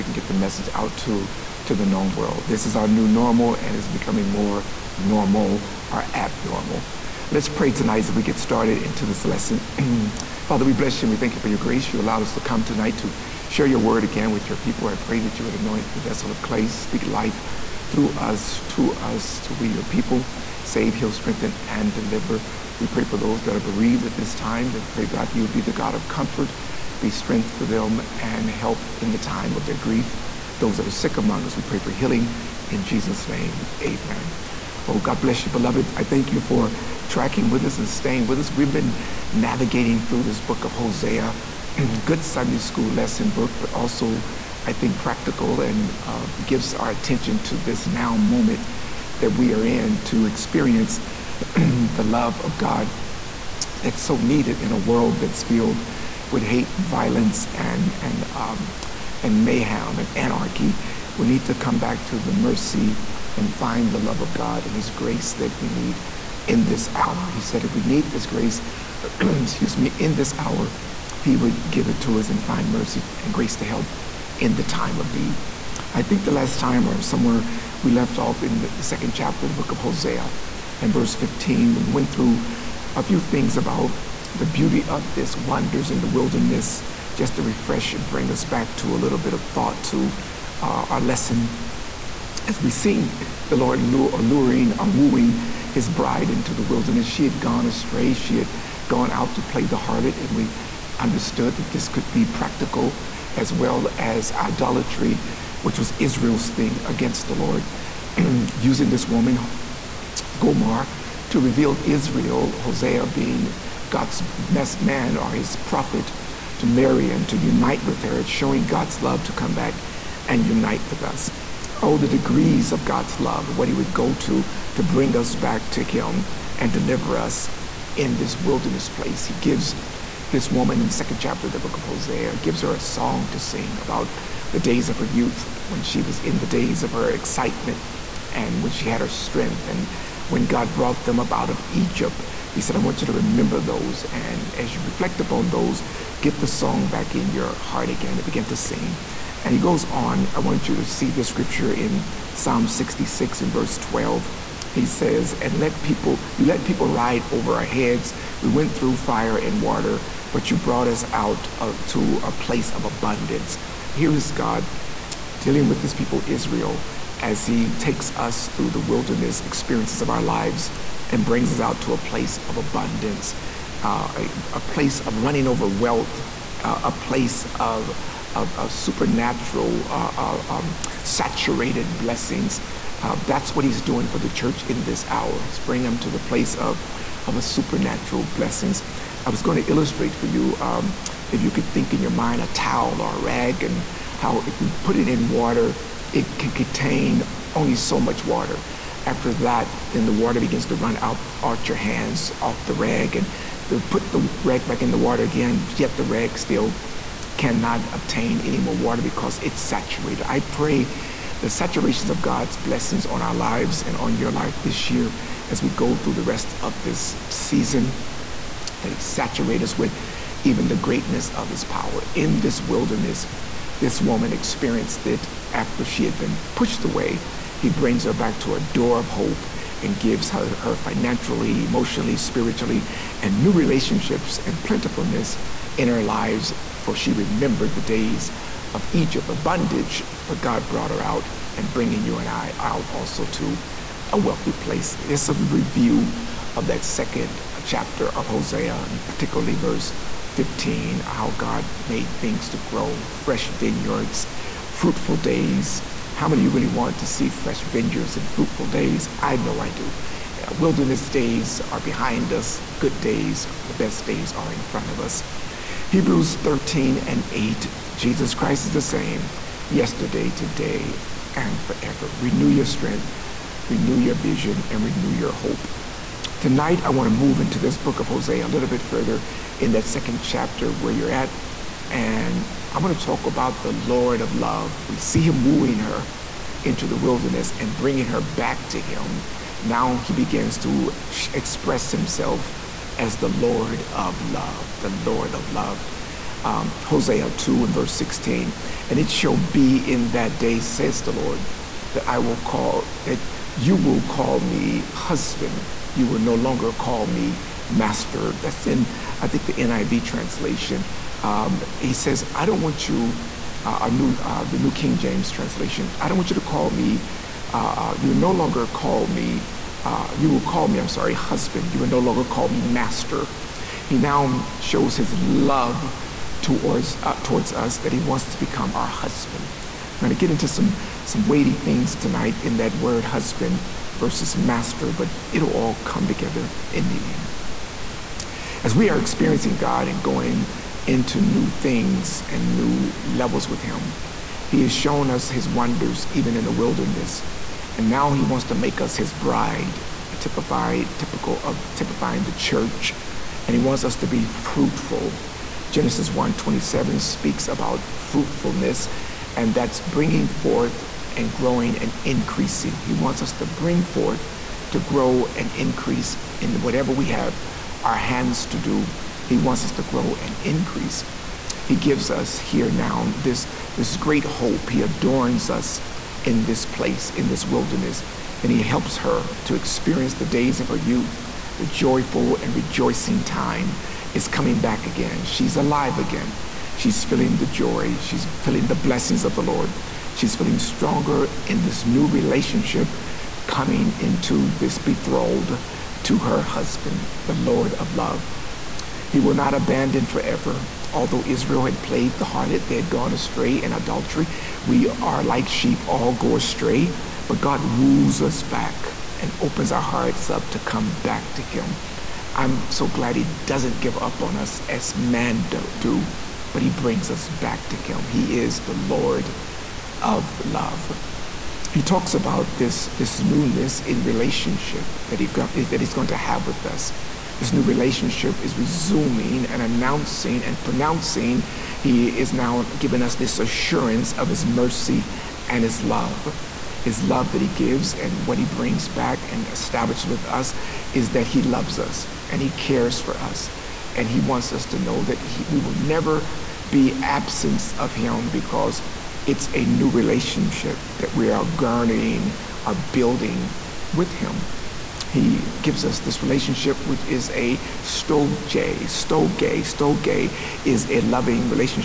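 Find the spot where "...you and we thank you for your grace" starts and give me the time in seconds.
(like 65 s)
11 s.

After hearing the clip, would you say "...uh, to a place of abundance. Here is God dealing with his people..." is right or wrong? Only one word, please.
right.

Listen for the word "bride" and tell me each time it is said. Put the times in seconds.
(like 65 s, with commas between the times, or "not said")
95 s, 349 s.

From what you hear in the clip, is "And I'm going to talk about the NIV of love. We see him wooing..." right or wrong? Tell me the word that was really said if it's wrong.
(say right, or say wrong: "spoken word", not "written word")
wrong: "Lord", not "NIV".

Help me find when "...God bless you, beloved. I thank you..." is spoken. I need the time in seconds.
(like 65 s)
34 s.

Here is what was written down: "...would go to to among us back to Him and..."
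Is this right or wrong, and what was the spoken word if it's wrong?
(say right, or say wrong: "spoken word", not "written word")
wrong: "bring", not "among".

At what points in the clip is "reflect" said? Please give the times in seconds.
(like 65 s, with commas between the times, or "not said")
144 s.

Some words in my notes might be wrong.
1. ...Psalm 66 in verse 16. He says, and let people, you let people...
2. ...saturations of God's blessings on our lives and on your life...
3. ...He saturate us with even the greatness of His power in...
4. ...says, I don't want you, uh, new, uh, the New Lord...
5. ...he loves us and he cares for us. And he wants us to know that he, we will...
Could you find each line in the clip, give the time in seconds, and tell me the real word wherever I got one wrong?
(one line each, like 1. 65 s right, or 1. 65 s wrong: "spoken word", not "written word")
1. 152 s wrong: "12", not "16"
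2. 211 s right
3. 218 s right
4. 311 s wrong: "King", not "Lord"
5. 441 s right.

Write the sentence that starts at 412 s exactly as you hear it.
I'm so glad He doesn't give up on us as man do, do but He brings us back to Him.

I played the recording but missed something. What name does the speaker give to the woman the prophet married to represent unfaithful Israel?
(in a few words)
Gomar.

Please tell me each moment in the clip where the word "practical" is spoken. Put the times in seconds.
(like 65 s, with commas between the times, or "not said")
44 s, 102 s.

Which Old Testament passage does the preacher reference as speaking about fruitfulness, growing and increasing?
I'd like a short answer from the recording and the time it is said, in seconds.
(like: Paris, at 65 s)
Genesis 27, at 355 s.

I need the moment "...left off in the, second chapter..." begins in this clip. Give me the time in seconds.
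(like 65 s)
77 s.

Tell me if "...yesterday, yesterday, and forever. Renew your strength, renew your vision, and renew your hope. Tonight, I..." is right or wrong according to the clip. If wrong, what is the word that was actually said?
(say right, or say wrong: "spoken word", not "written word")
wrong: "today", not "yesterday".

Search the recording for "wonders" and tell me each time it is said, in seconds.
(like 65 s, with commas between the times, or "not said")
85 s, 345 s.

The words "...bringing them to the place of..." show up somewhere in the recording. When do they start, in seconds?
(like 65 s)
185 s.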